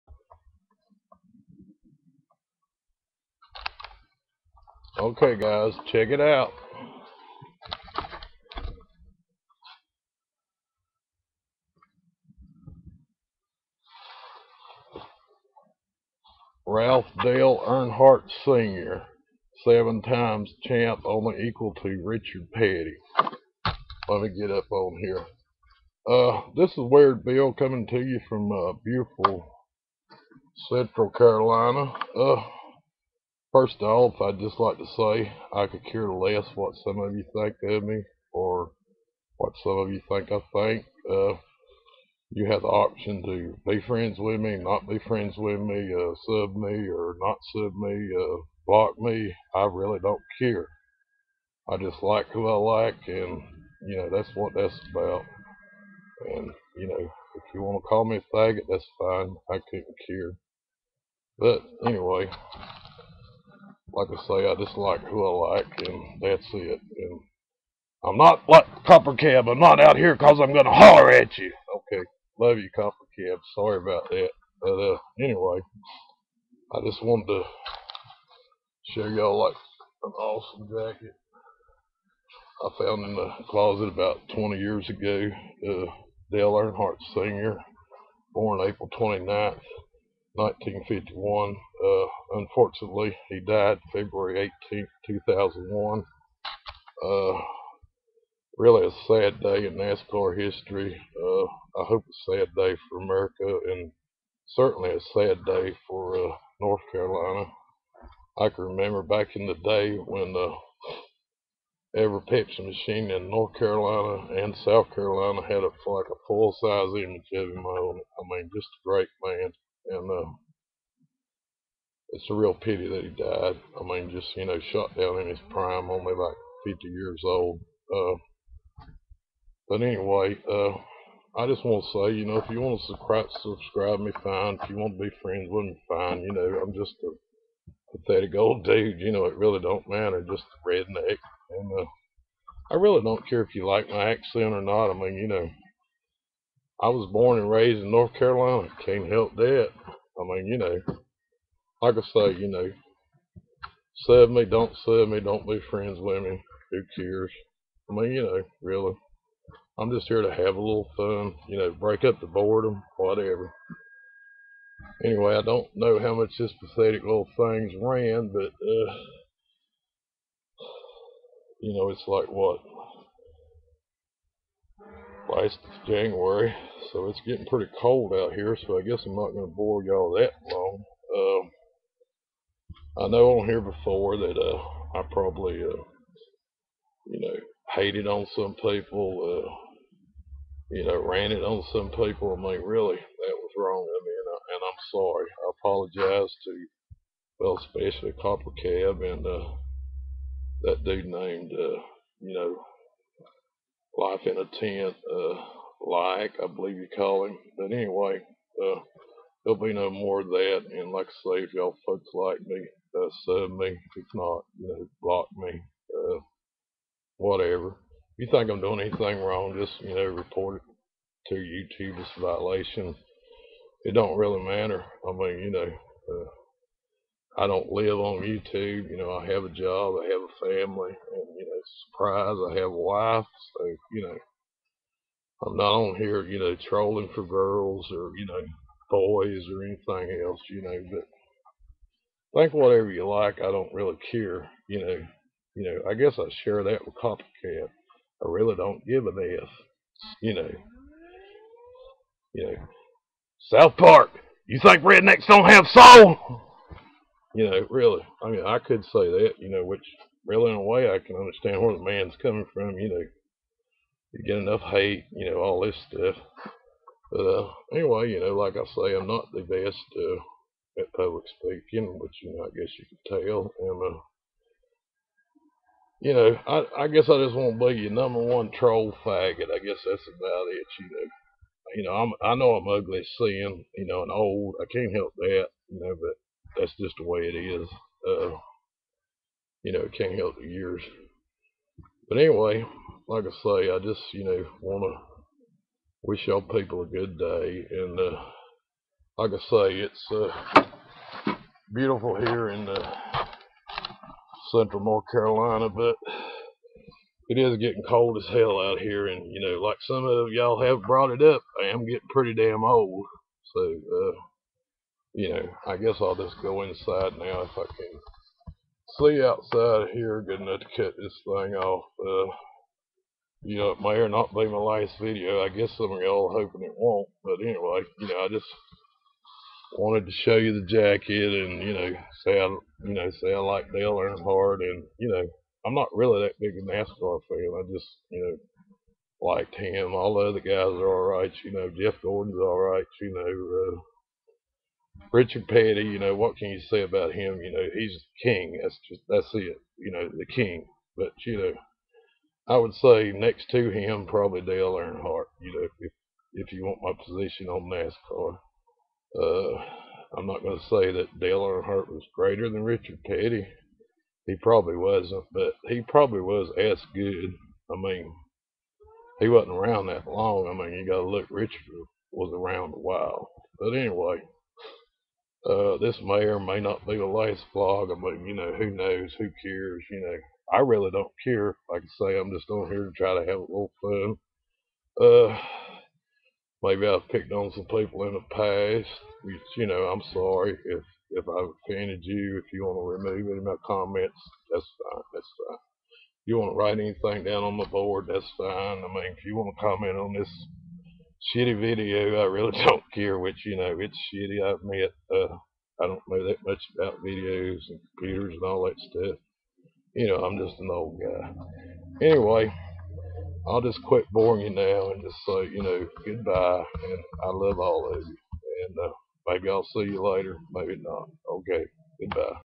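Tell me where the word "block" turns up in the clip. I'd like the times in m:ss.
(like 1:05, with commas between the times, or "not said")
0:48, 3:35.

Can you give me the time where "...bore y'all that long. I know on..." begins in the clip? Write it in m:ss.
2:59.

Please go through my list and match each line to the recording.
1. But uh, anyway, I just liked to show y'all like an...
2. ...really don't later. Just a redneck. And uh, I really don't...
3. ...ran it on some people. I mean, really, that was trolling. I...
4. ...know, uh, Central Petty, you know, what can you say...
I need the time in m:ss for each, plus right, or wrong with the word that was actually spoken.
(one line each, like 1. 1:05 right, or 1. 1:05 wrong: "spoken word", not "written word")
1. 1:14 wrong: "wanted", not "liked"
2. 2:19 wrong: "matter", not "later"
3. 3:11 wrong: "wrong", not "trolling"
4. 5:43 wrong: "Richard", not "Central".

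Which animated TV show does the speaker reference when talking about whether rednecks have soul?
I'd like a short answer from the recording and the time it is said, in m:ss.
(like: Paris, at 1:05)
South Park, at 4:13.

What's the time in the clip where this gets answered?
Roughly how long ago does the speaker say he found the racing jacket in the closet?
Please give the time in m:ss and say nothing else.
1:23.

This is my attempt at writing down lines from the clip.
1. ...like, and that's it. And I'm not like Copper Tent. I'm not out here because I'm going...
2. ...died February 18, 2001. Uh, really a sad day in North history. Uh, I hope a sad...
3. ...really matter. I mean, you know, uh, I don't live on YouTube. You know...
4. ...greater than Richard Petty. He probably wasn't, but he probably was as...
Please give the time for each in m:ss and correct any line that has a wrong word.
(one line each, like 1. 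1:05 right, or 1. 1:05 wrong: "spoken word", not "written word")
1. 1:05 wrong: "Cab", not "Tent"
2. 1:33 wrong: "NASCAR", not "North"
3. 3:44 right
4. 6:02 right.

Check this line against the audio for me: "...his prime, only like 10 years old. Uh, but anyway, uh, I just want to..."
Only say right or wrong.
wrong.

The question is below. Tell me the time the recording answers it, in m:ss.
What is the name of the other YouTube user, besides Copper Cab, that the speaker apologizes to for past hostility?
3:23.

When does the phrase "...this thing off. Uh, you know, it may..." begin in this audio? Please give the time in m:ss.
5:20.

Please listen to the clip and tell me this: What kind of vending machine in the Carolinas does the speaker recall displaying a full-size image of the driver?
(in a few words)
Pepsi machine.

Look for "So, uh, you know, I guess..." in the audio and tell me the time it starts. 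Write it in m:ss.
5:13.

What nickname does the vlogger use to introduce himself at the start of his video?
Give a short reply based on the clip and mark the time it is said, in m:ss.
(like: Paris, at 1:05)
Weird Bill, at 0:26.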